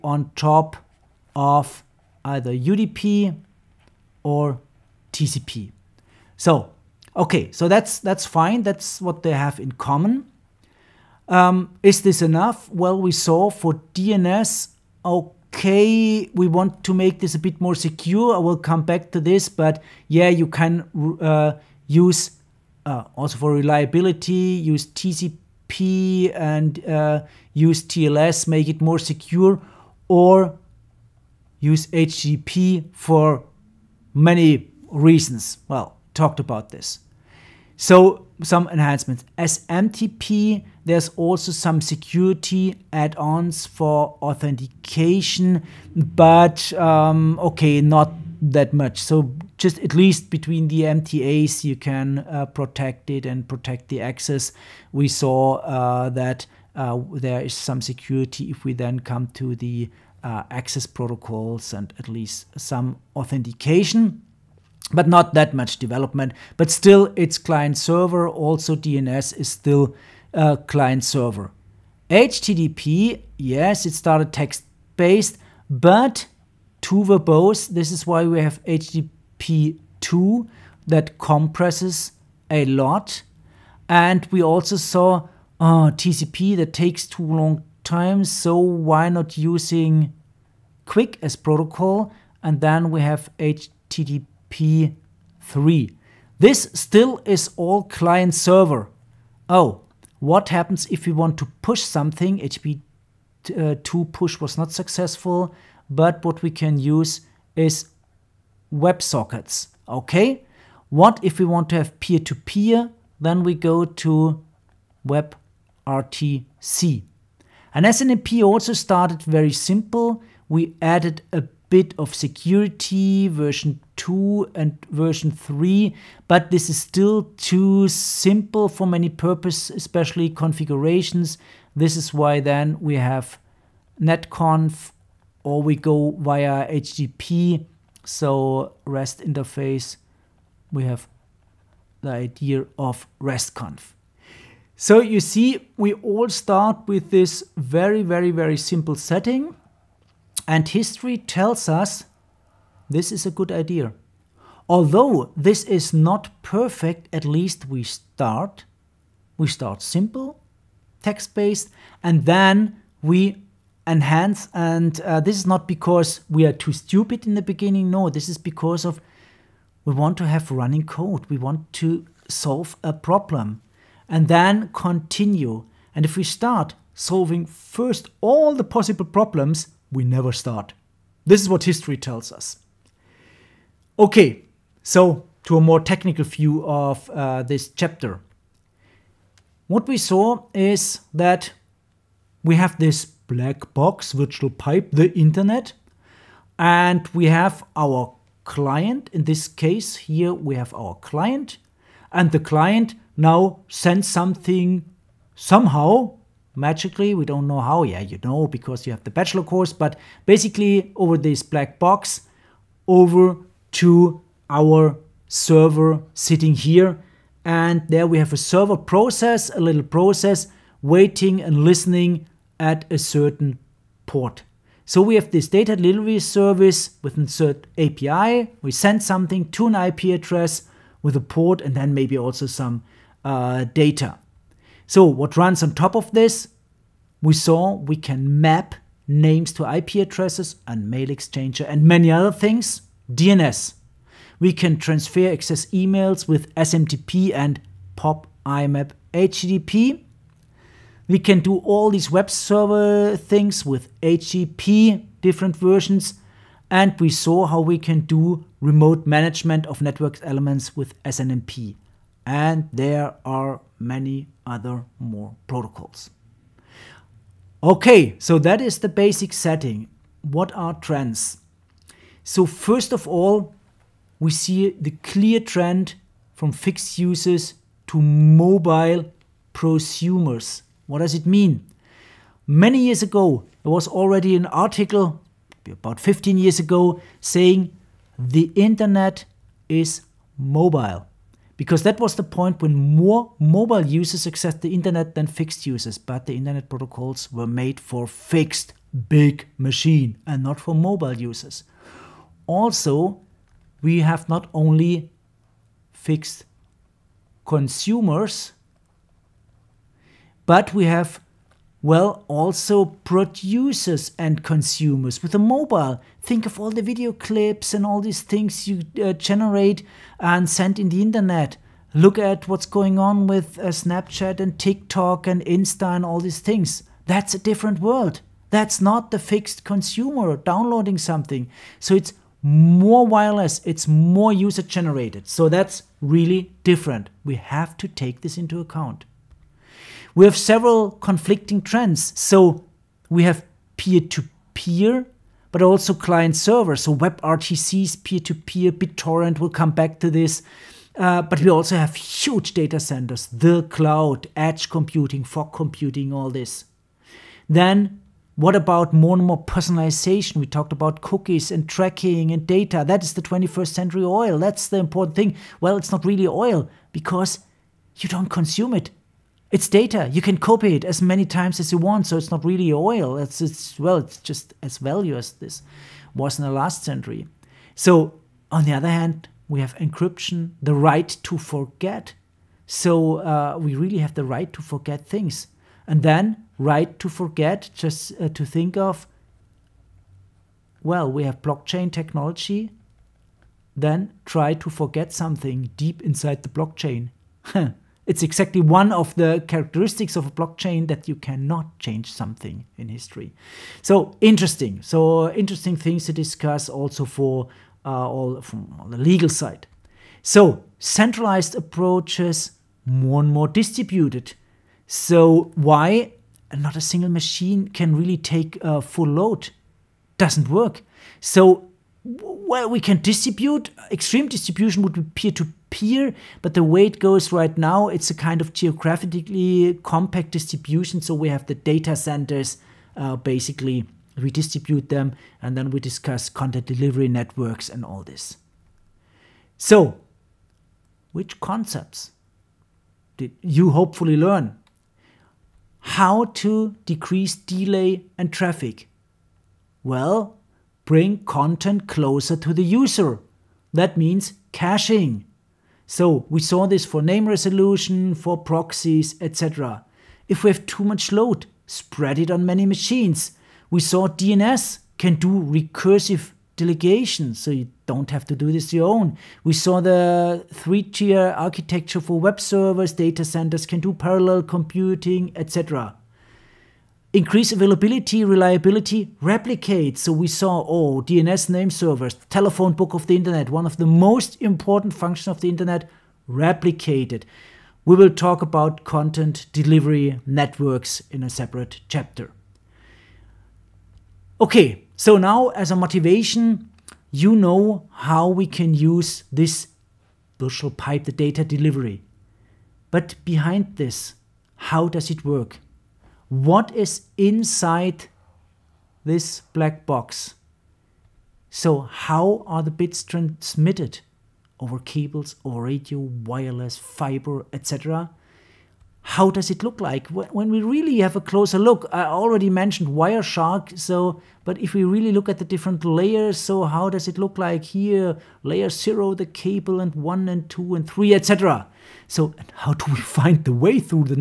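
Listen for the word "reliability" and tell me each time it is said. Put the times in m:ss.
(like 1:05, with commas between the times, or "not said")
0:23, 7:58.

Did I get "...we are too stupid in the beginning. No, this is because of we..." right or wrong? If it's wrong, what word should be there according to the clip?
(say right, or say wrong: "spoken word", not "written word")
right.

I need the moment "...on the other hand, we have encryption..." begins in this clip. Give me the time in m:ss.
6:18.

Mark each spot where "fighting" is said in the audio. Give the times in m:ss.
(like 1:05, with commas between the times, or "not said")
not said.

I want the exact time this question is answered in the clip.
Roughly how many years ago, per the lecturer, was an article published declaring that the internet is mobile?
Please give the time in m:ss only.
4:45.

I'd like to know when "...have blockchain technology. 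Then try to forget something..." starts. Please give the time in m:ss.
6:31.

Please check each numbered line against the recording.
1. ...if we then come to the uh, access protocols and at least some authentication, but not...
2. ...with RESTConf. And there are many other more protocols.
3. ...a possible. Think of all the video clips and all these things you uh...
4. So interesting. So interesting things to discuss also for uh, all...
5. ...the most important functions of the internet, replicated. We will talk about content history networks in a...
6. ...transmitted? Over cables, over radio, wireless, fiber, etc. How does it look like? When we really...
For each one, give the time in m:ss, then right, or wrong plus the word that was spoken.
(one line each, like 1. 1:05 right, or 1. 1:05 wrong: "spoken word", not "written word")
1. 0:58 right
2. 4:20 wrong: "SNMP", not "RESTConf"
3. 5:15 wrong: "mobile", not "possible"
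4. 6:43 right
5. 8:03 wrong: "delivery", not "history"
6. 8:33 right.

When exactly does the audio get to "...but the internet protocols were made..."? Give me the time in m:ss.
4:55.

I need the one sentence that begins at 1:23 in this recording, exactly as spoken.
And we also saw uh, TCP that takes too long time, so why not using QUIC as protocol?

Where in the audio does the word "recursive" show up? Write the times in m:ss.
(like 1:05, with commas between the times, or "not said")
7:45.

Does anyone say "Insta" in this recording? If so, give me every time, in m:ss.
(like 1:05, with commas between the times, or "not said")
5:25.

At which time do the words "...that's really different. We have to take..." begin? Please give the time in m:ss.
5:35.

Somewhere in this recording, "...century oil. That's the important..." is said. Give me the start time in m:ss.
6:03.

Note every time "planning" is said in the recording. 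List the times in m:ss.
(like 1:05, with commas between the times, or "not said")
not said.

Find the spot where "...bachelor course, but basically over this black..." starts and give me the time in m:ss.
3:29.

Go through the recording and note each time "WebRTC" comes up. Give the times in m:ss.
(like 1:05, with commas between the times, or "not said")
1:55, 5:46.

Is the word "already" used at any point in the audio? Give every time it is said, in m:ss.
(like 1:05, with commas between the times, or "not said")
4:43, 8:42.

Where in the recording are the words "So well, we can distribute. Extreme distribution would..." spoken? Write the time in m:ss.
7:01.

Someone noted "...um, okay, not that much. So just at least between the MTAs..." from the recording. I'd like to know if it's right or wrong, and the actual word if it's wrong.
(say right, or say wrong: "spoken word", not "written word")
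right.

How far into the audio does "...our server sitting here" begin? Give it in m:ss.
3:34.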